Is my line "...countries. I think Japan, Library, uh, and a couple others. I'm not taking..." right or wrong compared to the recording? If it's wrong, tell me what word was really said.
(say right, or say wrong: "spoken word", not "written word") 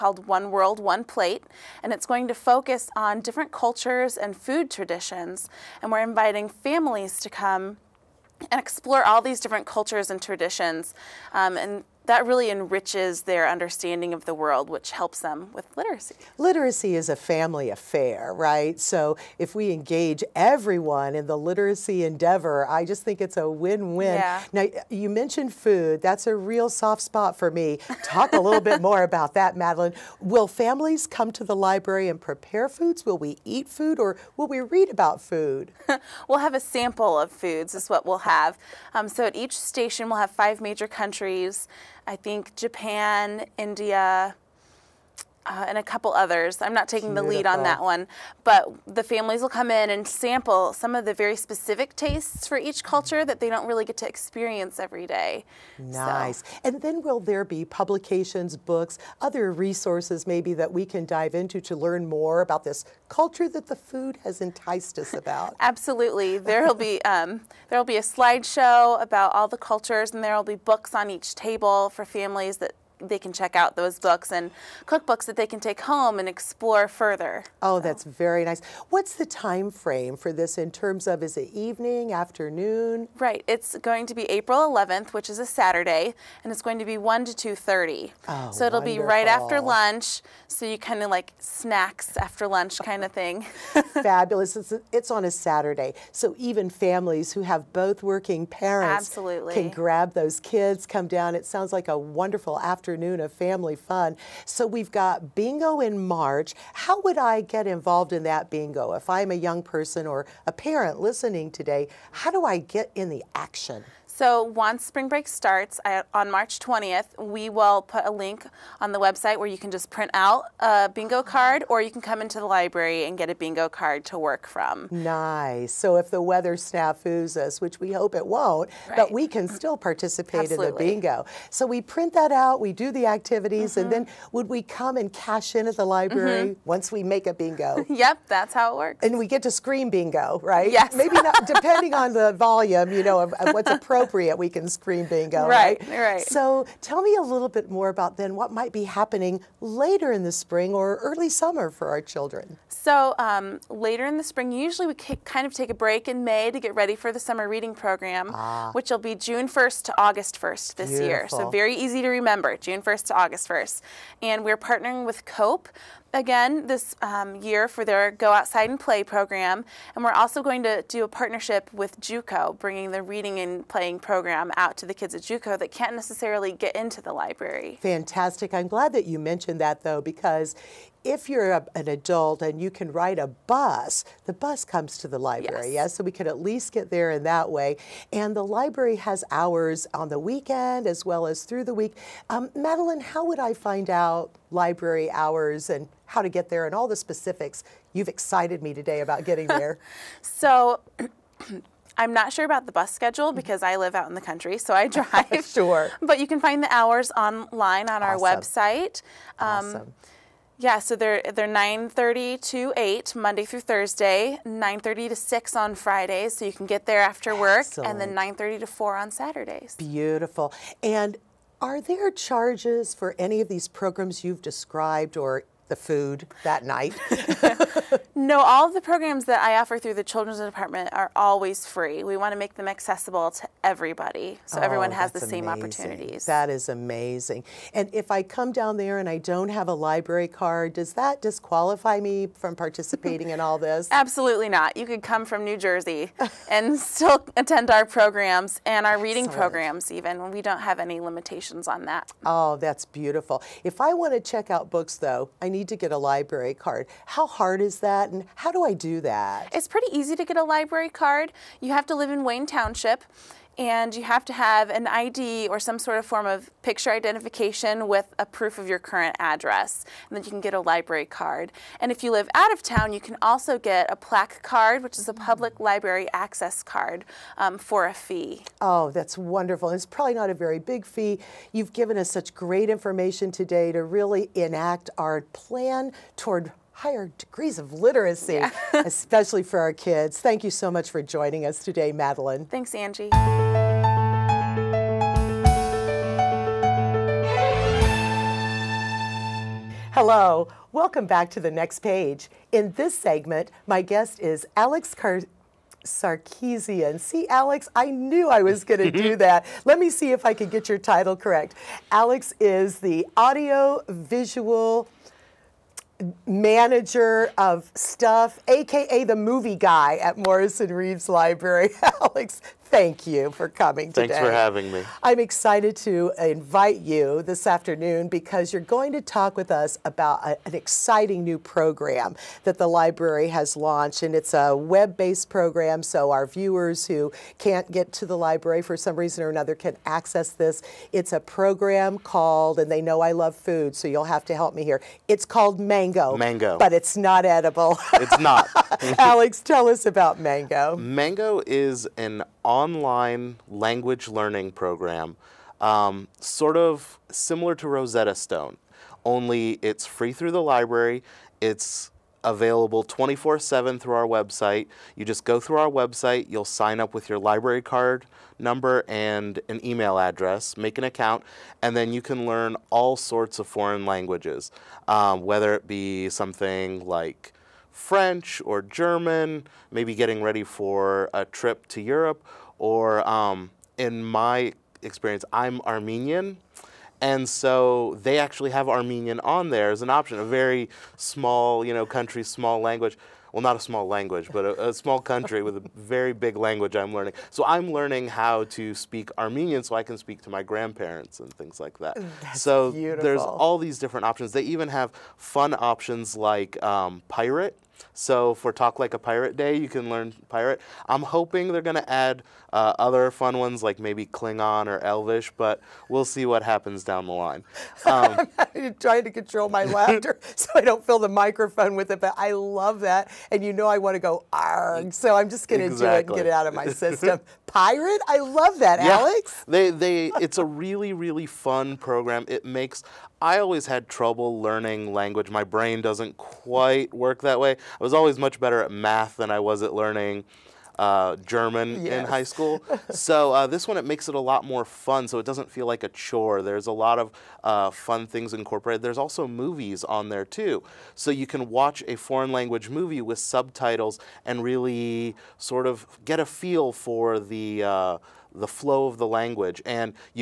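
wrong: "India", not "Library".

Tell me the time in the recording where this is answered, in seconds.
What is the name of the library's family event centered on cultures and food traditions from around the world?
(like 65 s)
0 s.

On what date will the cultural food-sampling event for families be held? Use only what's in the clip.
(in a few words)
April 11th.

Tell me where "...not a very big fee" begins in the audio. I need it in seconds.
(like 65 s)
280 s.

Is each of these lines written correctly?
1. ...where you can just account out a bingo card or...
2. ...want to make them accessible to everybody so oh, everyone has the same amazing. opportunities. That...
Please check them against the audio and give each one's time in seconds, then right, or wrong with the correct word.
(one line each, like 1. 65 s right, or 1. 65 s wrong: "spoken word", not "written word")
1. 119 s wrong: "print", not "account"
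2. 232 s right.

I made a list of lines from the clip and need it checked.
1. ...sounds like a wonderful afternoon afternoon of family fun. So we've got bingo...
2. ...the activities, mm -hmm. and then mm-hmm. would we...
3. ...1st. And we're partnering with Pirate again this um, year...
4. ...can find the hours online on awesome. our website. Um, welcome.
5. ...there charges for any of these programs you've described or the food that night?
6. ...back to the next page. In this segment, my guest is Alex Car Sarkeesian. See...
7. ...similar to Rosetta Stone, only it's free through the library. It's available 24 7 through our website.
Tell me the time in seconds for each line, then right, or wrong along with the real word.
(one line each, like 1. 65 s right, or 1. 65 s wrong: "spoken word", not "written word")
1. 101 s right
2. 132 s right
3. 163 s wrong: "COPE", not "Pirate"
4. 206 s wrong: "awesome", not "welcome"
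5. 221 s right
6. 301 s right
7. 357 s right.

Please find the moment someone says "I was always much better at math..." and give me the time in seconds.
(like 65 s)
437 s.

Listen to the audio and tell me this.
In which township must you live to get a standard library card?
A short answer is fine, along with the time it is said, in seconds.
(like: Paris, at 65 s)
Wayne Township, at 262 s.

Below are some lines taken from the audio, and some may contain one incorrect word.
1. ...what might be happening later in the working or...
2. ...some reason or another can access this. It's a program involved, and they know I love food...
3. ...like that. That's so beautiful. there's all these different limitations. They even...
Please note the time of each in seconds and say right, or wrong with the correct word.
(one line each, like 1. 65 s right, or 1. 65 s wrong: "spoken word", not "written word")
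1. 148 s wrong: "spring", not "working"
2. 338 s wrong: "called", not "involved"
3. 401 s wrong: "options", not "limitations".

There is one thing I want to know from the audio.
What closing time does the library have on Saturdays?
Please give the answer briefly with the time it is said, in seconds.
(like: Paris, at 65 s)
4, at 218 s.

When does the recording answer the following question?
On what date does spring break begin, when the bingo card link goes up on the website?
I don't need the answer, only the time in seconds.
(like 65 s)
116 s.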